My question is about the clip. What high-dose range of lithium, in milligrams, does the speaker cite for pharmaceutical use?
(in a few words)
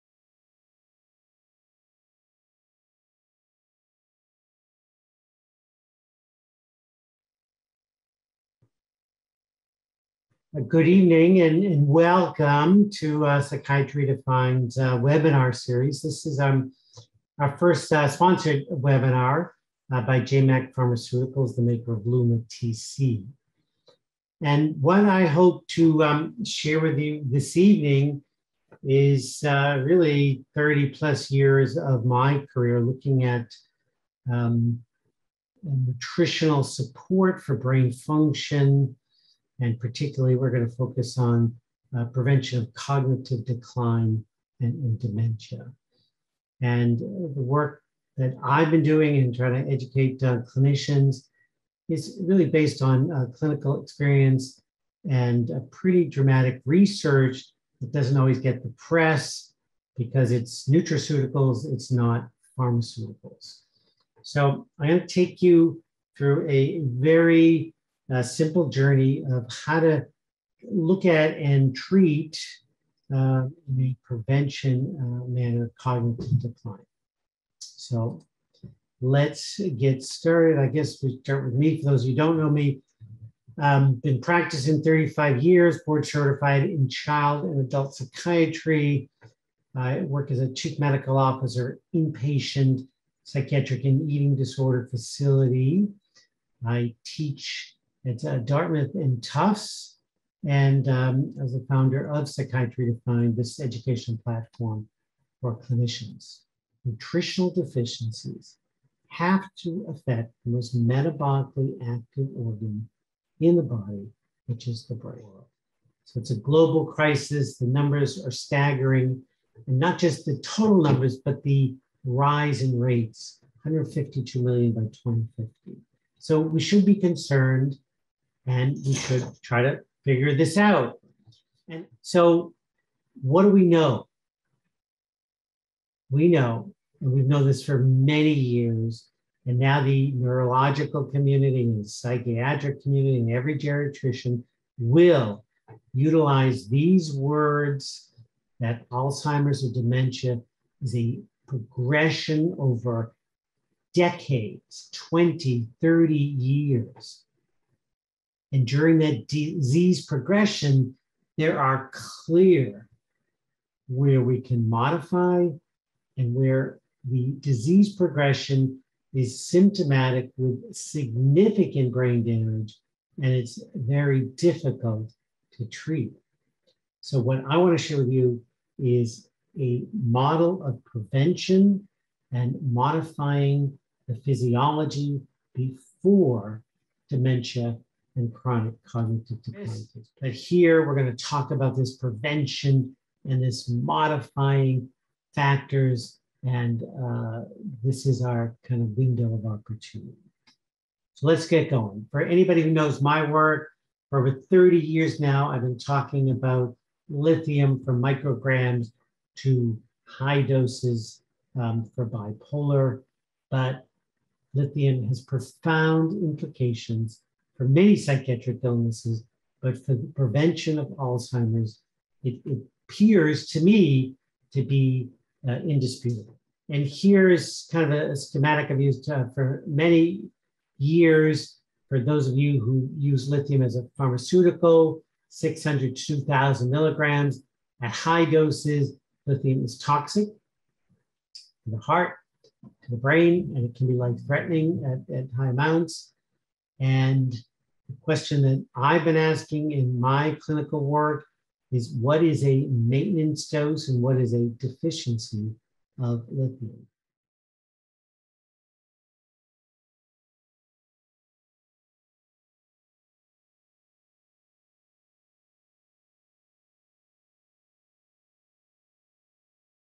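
600 to 2,000 milligrams.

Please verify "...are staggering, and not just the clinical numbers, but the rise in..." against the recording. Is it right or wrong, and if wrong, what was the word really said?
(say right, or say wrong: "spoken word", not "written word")
wrong: "total", not "clinical".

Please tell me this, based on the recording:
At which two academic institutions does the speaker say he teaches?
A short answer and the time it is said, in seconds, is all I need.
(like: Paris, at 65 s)
Dartmouth and Tufts, at 98 s.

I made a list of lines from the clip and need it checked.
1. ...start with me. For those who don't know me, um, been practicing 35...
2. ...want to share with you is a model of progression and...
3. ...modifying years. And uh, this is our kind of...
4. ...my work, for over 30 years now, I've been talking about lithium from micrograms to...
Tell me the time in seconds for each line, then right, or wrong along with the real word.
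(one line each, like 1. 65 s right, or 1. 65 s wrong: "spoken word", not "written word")
1. 81 s right
2. 177 s wrong: "prevention", not "progression"
3. 193 s wrong: "factors", not "years"
4. 203 s right.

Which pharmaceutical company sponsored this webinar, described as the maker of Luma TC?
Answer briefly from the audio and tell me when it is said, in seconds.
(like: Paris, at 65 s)
JayMac Pharmaceuticals, at 20 s.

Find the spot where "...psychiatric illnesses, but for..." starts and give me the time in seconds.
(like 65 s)
217 s.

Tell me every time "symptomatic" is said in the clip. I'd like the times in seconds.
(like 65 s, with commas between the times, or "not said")
169 s.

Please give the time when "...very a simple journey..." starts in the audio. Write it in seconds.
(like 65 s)
66 s.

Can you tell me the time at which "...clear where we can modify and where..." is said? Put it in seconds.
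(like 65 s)
161 s.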